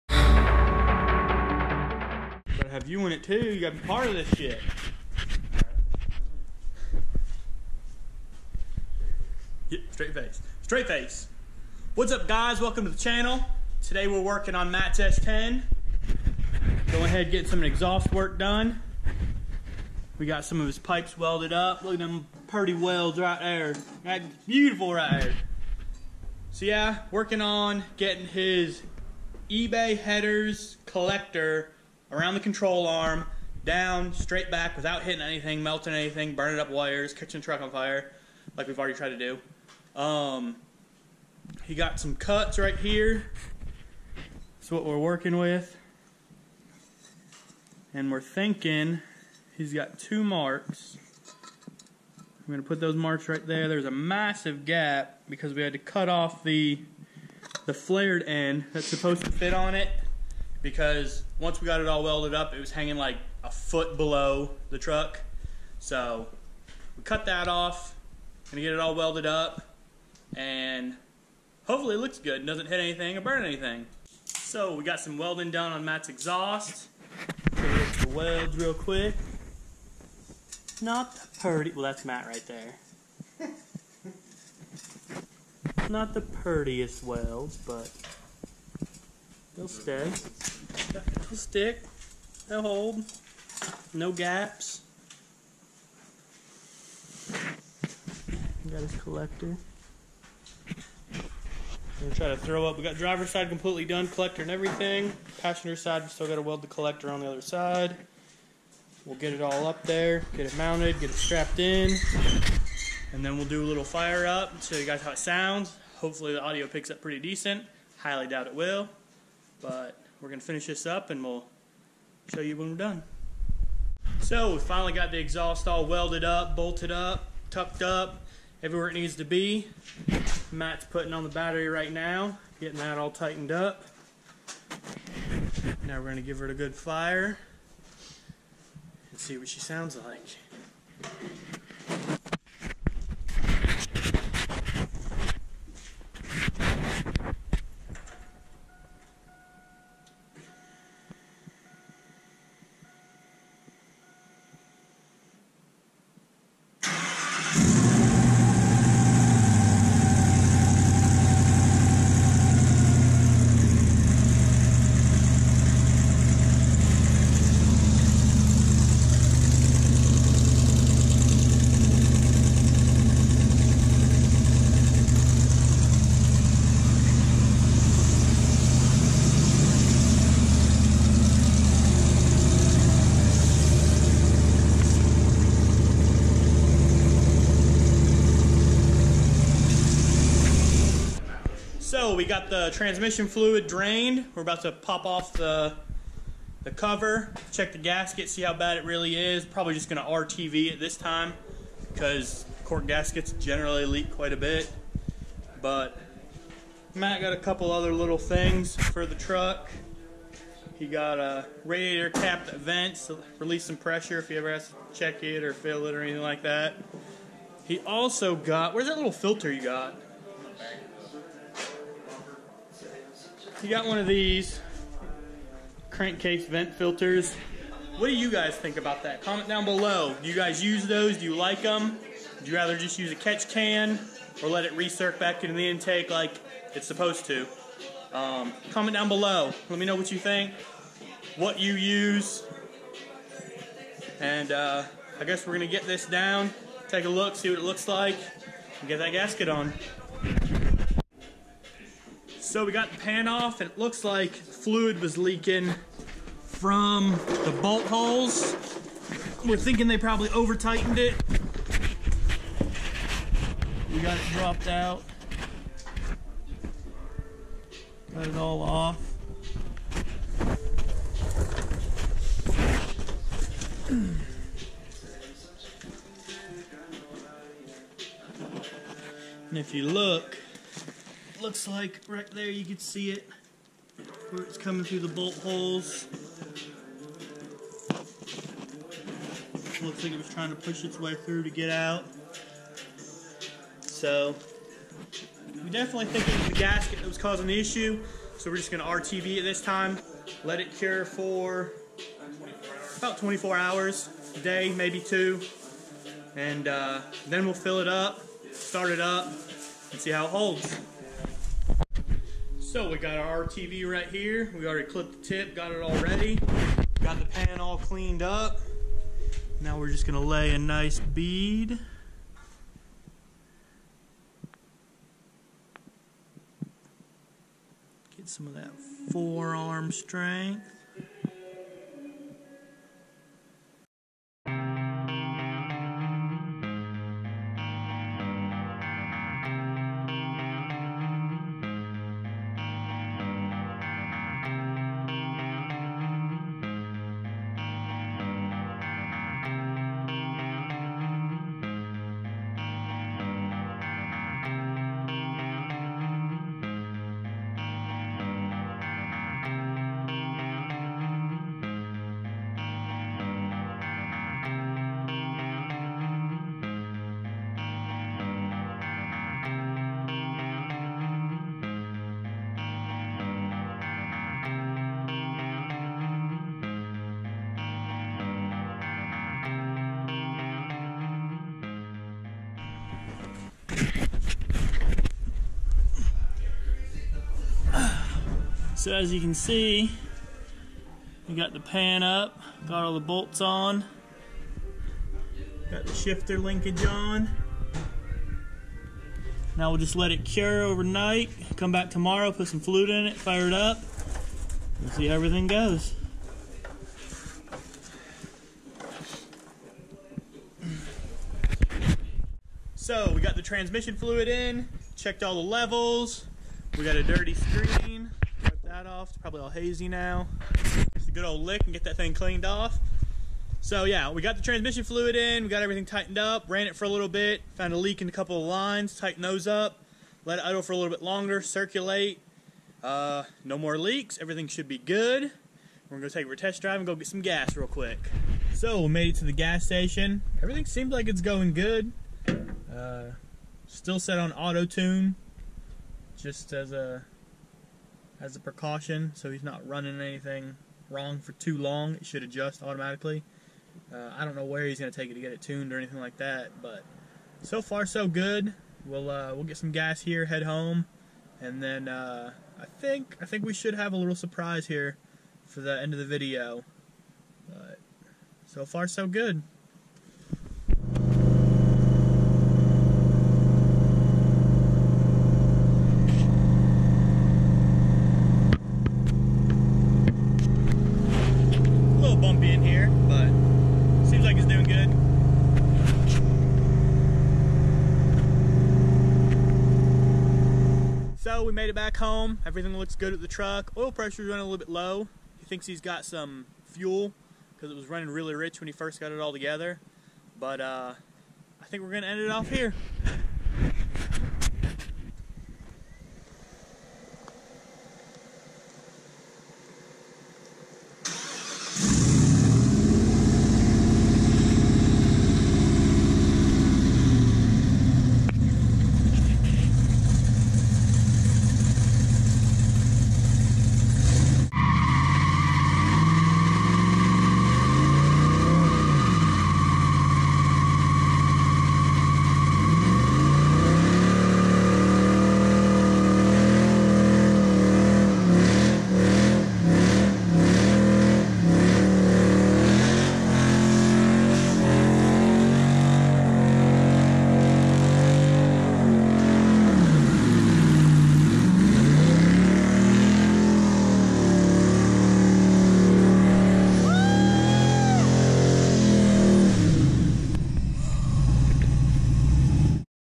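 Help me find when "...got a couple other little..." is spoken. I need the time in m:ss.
3:27.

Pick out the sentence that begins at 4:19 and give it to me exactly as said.
We're thinking they probably over tightened it.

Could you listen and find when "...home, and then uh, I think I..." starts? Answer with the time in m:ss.
7:40.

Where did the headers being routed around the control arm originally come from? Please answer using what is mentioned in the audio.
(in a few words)
eBay.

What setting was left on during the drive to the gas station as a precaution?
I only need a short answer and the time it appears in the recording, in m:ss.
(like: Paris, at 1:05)
Auto tune, at 7:24.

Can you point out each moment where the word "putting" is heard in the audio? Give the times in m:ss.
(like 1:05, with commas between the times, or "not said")
2:10.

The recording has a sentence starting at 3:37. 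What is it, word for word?
He also got, where's that little filter you got?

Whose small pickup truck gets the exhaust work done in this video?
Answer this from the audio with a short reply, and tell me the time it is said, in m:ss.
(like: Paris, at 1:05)
Matt's S10, at 0:14.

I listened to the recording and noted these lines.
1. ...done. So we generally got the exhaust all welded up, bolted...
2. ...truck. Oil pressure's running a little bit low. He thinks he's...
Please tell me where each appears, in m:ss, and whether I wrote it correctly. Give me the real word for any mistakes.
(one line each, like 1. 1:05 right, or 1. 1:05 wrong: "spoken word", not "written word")
1. 2:02 wrong: "finally", not "generally"
2. 8:13 right.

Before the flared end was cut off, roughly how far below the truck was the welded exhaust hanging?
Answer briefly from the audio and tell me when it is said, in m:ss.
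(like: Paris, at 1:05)
A foot, at 1:03.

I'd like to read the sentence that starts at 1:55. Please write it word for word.
Hopefully the audio picks up pretty decent.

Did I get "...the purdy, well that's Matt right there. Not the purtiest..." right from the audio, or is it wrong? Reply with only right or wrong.
right.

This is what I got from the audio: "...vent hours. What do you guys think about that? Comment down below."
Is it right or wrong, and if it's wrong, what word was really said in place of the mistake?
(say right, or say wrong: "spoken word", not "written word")
wrong: "filters", not "hours".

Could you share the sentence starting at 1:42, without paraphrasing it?
We got driver side completely done, collector and everything.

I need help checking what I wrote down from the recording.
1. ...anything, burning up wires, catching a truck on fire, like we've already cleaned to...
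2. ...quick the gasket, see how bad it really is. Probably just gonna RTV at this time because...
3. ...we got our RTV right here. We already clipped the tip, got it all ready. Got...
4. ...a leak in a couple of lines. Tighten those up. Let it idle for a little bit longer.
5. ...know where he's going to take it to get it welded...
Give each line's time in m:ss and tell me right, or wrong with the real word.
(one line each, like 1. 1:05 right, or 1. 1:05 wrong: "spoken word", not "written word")
1. 0:35 wrong: "tried", not "cleaned"
2. 3:17 wrong: "check", not "quick"
3. 5:12 right
4. 7:07 right
5. 7:34 wrong: "tuned", not "welded".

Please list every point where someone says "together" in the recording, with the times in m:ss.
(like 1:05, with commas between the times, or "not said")
8:19.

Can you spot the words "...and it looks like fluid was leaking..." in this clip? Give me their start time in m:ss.
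4:13.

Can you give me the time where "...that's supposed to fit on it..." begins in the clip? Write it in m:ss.
0:58.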